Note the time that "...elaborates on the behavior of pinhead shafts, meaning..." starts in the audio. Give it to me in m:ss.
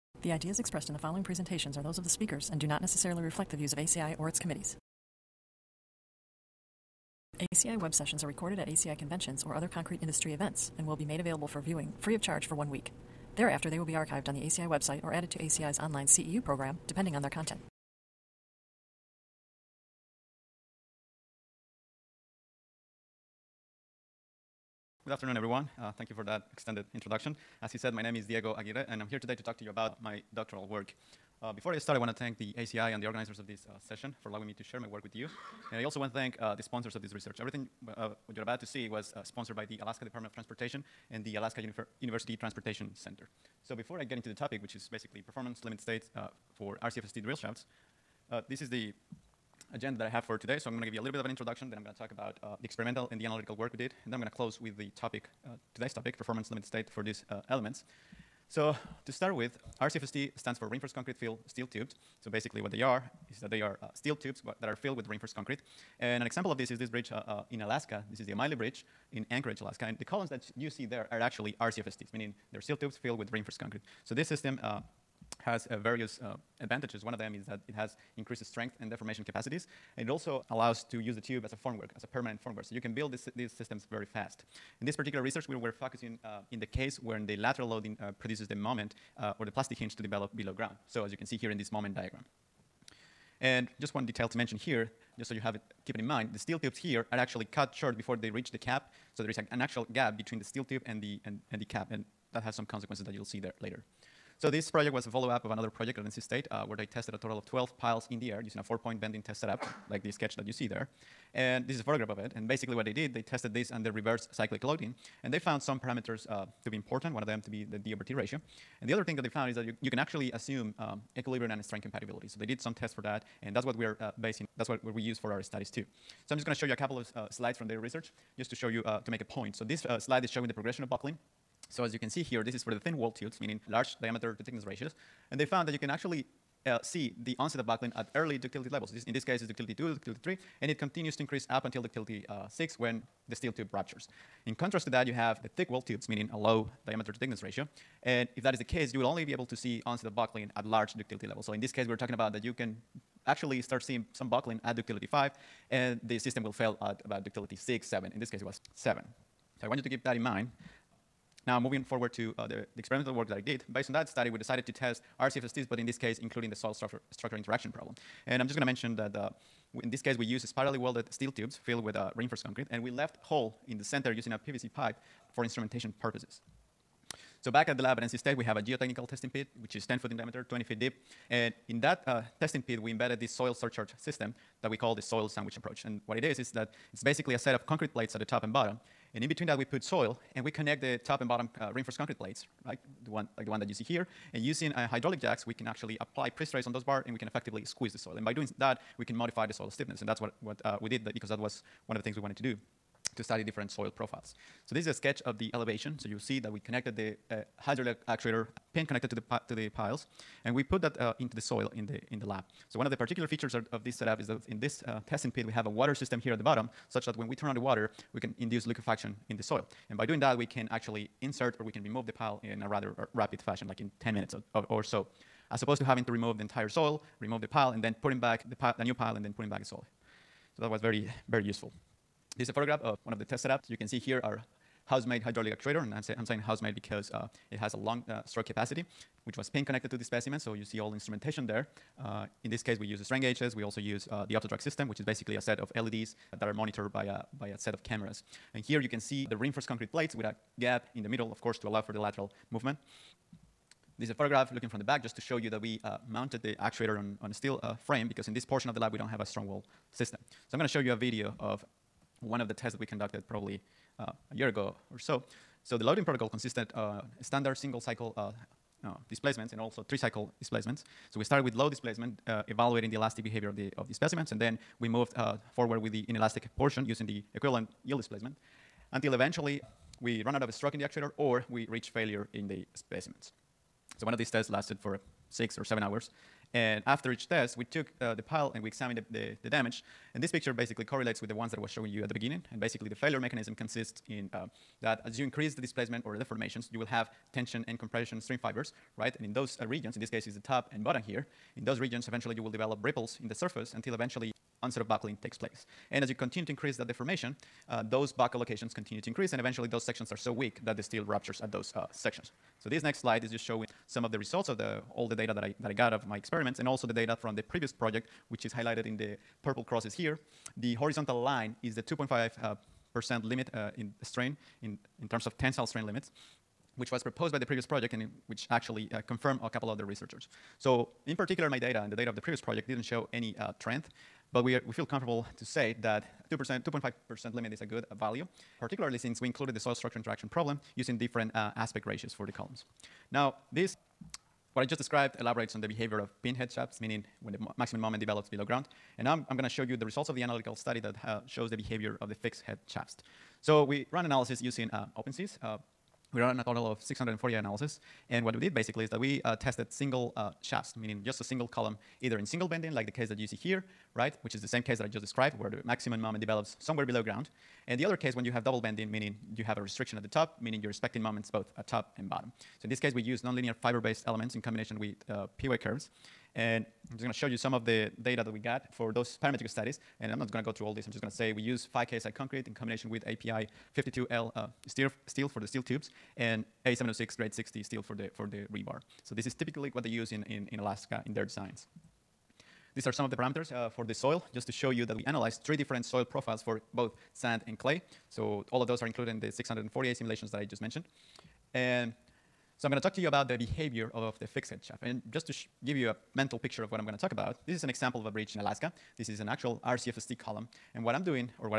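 5:45.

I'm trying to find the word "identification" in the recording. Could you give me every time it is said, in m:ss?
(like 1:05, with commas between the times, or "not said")
not said.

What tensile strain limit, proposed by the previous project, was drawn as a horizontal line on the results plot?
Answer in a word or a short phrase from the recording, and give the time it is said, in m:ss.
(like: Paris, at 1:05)
2.5%, at 5:21.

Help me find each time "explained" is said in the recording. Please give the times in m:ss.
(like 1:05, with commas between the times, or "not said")
not said.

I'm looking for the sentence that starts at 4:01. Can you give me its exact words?
Uh, in this case, we use strain gauges.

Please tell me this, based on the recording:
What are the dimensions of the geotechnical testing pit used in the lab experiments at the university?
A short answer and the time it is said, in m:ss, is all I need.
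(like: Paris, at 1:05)
10 foot diameter, 20 feet deep, at 2:59.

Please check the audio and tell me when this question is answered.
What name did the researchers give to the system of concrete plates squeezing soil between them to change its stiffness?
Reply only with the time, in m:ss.
3:04.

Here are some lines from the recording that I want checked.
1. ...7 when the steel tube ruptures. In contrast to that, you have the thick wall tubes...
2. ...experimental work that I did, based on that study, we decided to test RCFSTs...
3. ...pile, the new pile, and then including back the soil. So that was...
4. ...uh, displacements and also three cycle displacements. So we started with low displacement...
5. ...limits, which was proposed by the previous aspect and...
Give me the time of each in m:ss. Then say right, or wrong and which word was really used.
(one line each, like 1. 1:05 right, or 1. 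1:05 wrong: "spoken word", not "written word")
1. 2:22 wrong: "6", not "7"
2. 2:42 right
3. 3:48 wrong: "putting", not "including"
4. 4:28 right
5. 5:25 wrong: "project", not "aspect".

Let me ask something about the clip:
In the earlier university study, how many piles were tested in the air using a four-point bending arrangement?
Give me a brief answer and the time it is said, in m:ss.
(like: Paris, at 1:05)
12, at 1:47.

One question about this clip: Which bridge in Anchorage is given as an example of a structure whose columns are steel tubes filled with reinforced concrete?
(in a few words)
O'Malley Bridge.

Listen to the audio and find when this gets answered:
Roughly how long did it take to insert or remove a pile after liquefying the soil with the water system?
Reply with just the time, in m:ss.
3:44.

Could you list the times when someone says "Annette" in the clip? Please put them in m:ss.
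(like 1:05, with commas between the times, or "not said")
not said.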